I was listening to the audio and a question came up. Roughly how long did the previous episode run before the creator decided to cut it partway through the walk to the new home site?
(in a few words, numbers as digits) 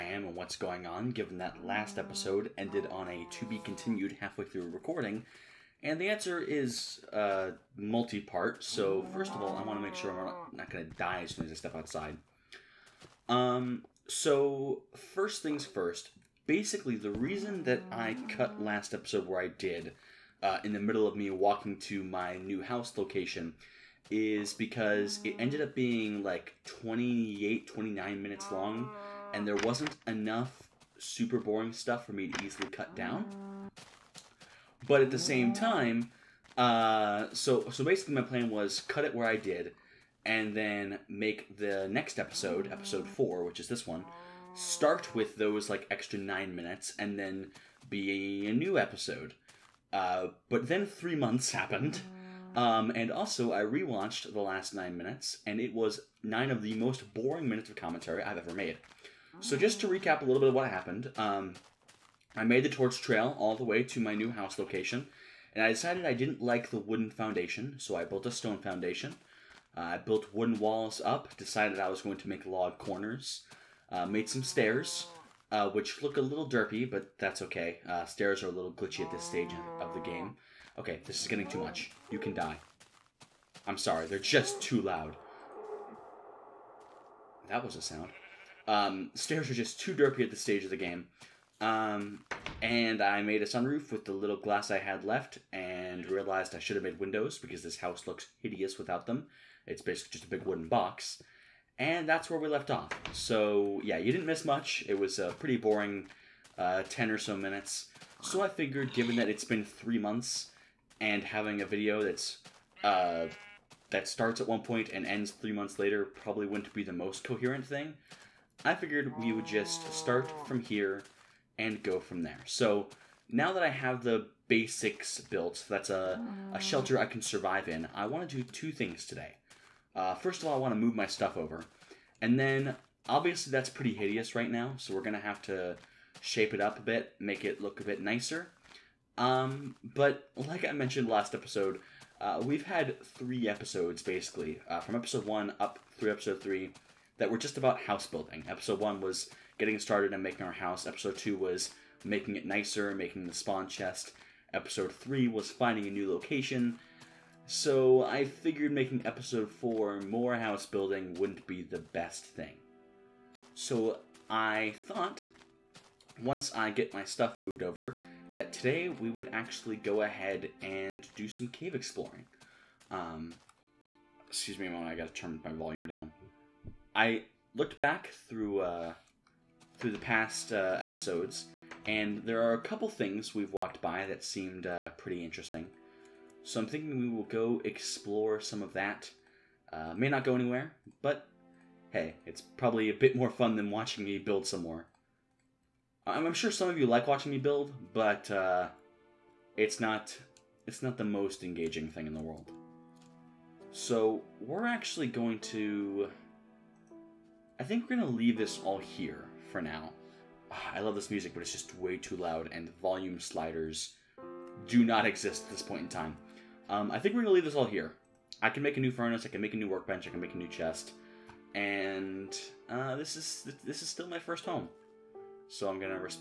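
28, 29 minutes.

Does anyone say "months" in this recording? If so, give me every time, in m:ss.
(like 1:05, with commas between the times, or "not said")
0:51, 1:49, 1:55.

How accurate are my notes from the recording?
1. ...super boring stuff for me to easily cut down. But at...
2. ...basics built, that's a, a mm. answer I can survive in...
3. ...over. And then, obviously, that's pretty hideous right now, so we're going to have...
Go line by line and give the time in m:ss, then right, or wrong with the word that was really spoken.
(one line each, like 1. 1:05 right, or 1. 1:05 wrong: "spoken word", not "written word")
1. 0:30 right
2. 2:04 wrong: "shelter", not "answer"
3. 2:11 right.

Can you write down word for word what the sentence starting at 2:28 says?
Episode one was getting started and making our house.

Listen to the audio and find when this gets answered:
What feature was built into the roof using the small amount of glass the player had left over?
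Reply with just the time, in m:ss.
1:33.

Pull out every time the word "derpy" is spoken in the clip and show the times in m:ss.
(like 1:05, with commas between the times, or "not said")
1:16, 1:29.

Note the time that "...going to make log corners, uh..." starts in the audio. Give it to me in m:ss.
1:12.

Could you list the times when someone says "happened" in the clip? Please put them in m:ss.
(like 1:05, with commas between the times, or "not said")
0:51, 1:00.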